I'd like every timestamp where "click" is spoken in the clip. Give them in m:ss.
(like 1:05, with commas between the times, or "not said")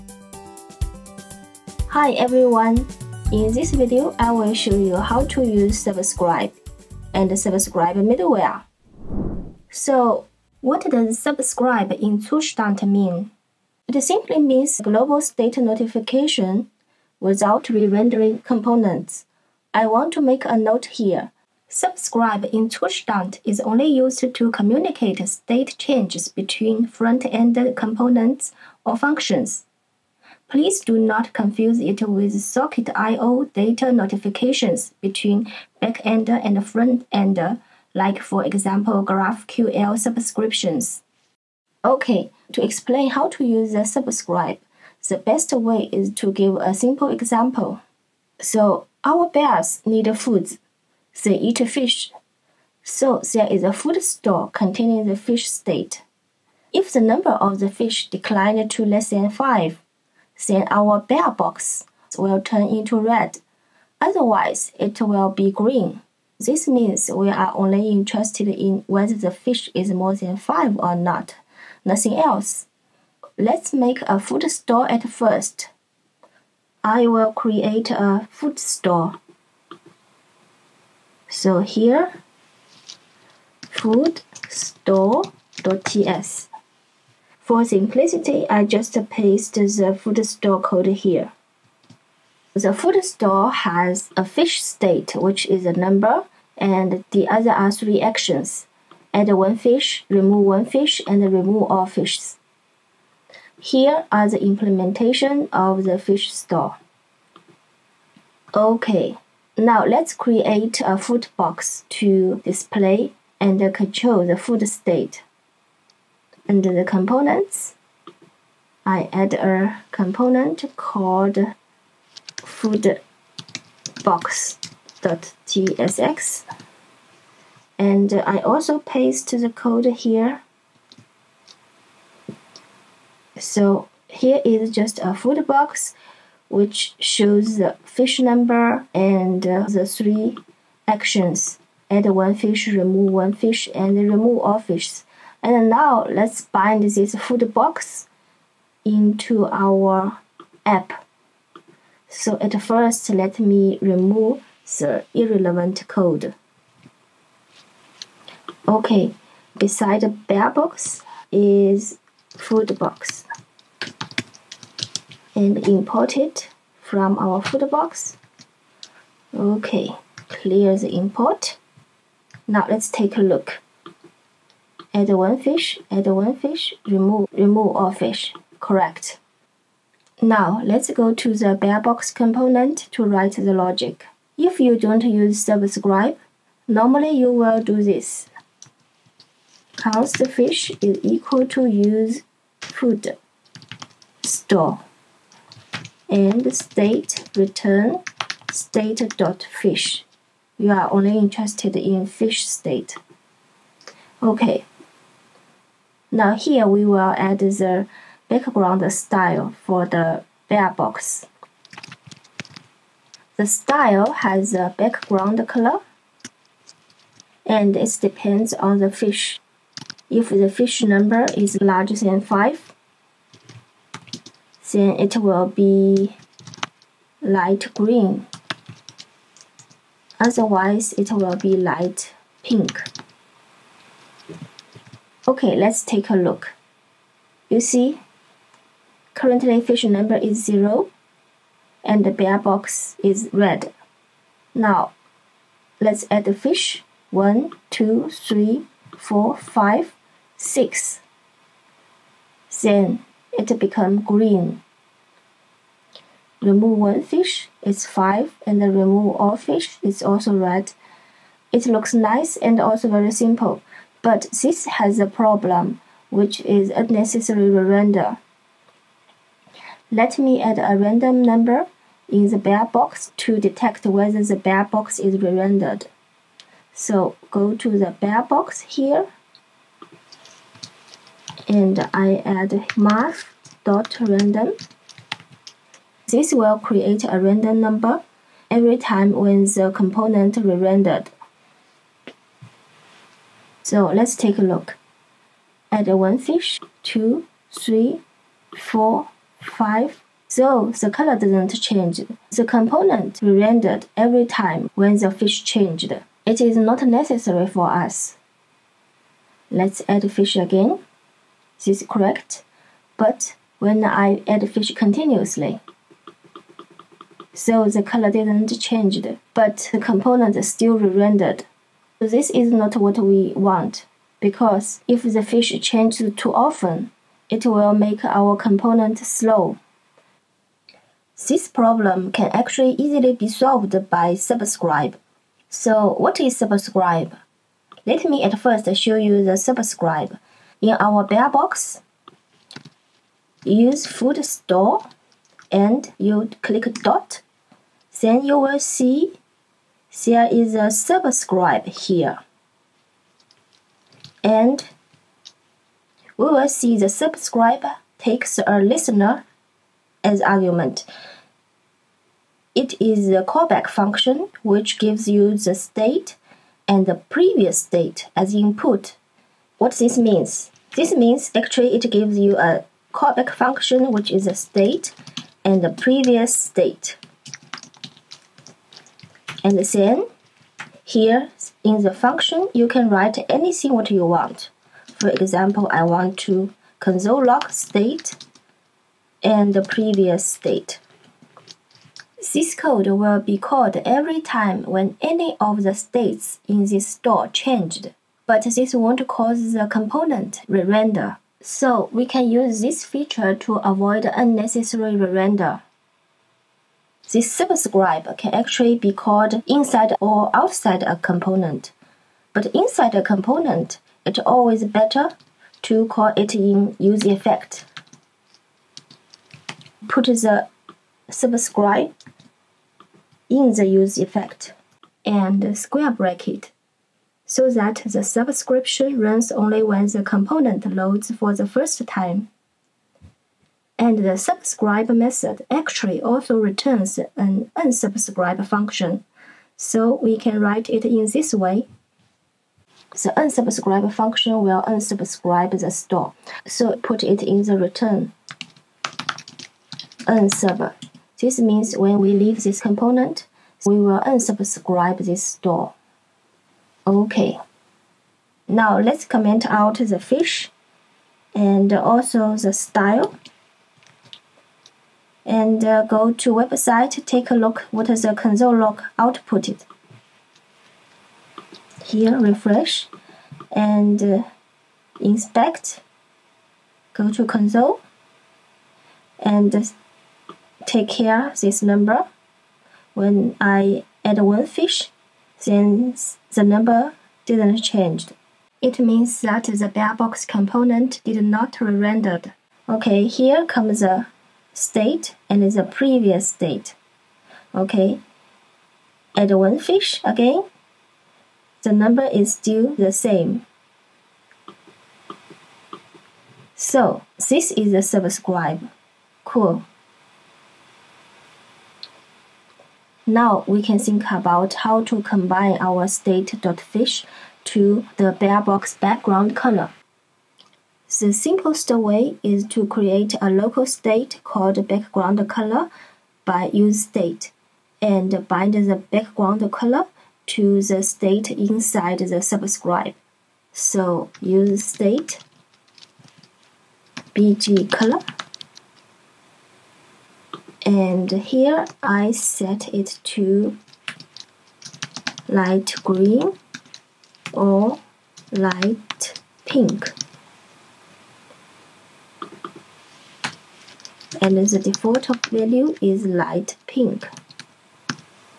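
5:46.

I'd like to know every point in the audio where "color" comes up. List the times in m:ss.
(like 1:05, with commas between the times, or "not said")
3:35, 5:00, 5:17, 8:39, 8:45, 8:49, 8:57.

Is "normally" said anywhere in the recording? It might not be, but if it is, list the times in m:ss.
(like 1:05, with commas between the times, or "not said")
3:06.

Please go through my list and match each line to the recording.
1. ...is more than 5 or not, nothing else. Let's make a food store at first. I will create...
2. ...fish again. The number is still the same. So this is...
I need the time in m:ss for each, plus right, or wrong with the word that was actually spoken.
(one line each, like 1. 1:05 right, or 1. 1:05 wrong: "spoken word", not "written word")
1. 1:09 right
2. 8:19 right.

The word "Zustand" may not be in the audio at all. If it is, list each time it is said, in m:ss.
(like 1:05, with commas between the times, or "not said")
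0:12, 0:22.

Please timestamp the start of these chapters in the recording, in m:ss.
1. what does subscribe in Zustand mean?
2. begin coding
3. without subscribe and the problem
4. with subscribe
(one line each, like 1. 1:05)
1. 0:10
2. 1:08
3. 3:04
4. 5:26.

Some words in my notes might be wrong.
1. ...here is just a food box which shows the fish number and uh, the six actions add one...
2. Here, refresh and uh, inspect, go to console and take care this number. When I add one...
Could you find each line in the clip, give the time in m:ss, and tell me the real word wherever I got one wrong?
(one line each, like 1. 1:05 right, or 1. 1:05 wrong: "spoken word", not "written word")
1. 2:14 wrong: "three", not "six"
2. 7:51 right.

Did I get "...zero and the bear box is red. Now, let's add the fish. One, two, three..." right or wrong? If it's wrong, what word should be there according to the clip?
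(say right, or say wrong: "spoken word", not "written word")
right.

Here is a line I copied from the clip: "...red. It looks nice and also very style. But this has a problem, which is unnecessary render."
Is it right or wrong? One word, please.
wrong.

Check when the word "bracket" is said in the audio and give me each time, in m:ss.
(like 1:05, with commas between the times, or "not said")
7:05.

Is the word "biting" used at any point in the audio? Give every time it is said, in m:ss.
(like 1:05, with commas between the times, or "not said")
not said.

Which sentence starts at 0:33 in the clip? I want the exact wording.
data notifications between backend and front like for example GraphQL subscriptions.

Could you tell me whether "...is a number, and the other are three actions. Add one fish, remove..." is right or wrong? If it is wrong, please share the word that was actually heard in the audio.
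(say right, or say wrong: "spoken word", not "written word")
right.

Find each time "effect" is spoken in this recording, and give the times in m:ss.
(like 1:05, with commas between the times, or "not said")
6:57, 7:03.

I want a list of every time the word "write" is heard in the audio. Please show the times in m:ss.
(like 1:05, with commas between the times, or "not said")
3:03, 6:22, 7:20.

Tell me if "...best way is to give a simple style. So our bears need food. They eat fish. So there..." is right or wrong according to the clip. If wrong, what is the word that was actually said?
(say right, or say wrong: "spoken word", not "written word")
wrong: "example", not "style".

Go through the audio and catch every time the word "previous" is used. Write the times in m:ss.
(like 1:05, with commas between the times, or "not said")
6:07, 6:15, 6:29, 8:15.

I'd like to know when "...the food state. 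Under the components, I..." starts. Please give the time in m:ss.
1:54.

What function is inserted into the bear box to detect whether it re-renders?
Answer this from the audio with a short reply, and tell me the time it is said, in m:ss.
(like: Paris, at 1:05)
math.random, at 4:42.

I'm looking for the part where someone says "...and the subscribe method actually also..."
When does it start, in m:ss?
7:13.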